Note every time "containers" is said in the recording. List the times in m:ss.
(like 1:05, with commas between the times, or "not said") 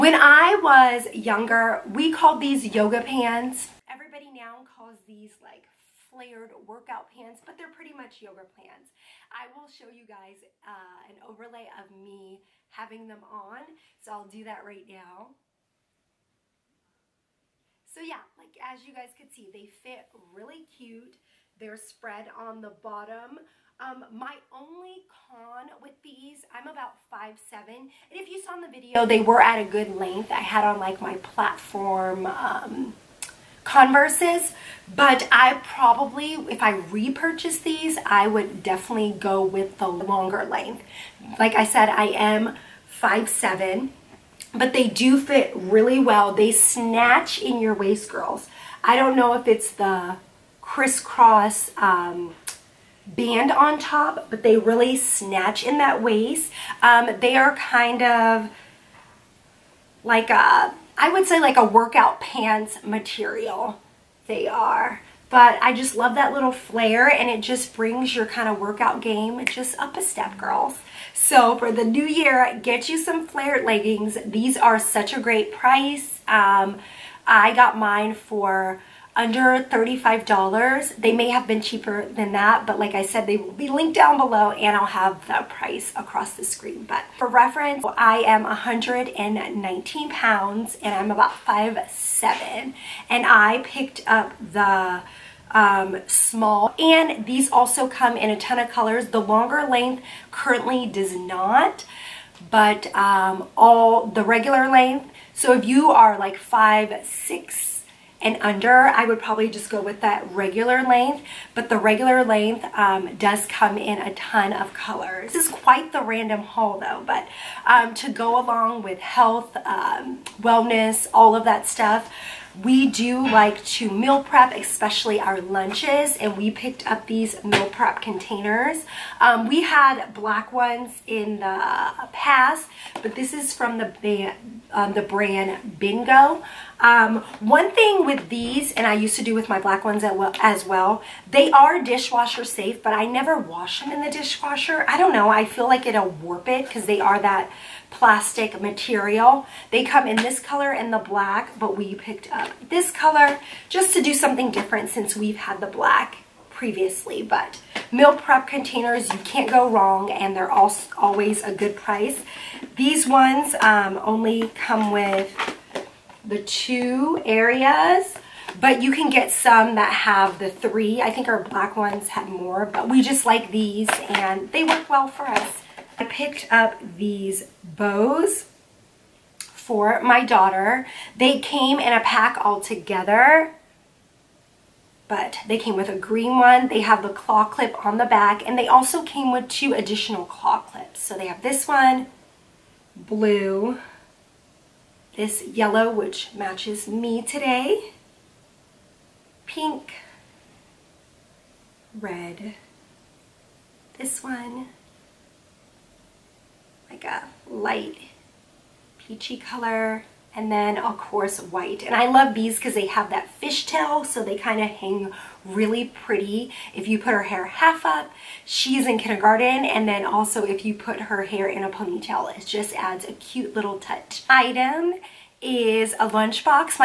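2:08, 2:38.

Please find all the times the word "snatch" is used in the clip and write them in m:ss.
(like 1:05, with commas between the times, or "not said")
0:46, 0:54.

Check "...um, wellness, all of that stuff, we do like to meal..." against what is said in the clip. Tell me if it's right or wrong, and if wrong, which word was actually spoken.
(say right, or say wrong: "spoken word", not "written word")
right.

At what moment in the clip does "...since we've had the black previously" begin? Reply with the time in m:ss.
2:34.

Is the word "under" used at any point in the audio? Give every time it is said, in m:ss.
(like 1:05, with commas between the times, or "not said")
1:19, 1:48.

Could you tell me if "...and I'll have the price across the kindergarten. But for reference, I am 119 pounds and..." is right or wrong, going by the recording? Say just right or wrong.
wrong.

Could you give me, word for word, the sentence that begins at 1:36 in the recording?
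And these also come in a ton of colors.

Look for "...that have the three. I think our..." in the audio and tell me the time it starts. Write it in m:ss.
2:49.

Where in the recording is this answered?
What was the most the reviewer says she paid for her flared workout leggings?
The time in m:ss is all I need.
1:19.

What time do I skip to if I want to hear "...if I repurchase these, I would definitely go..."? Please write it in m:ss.
0:36.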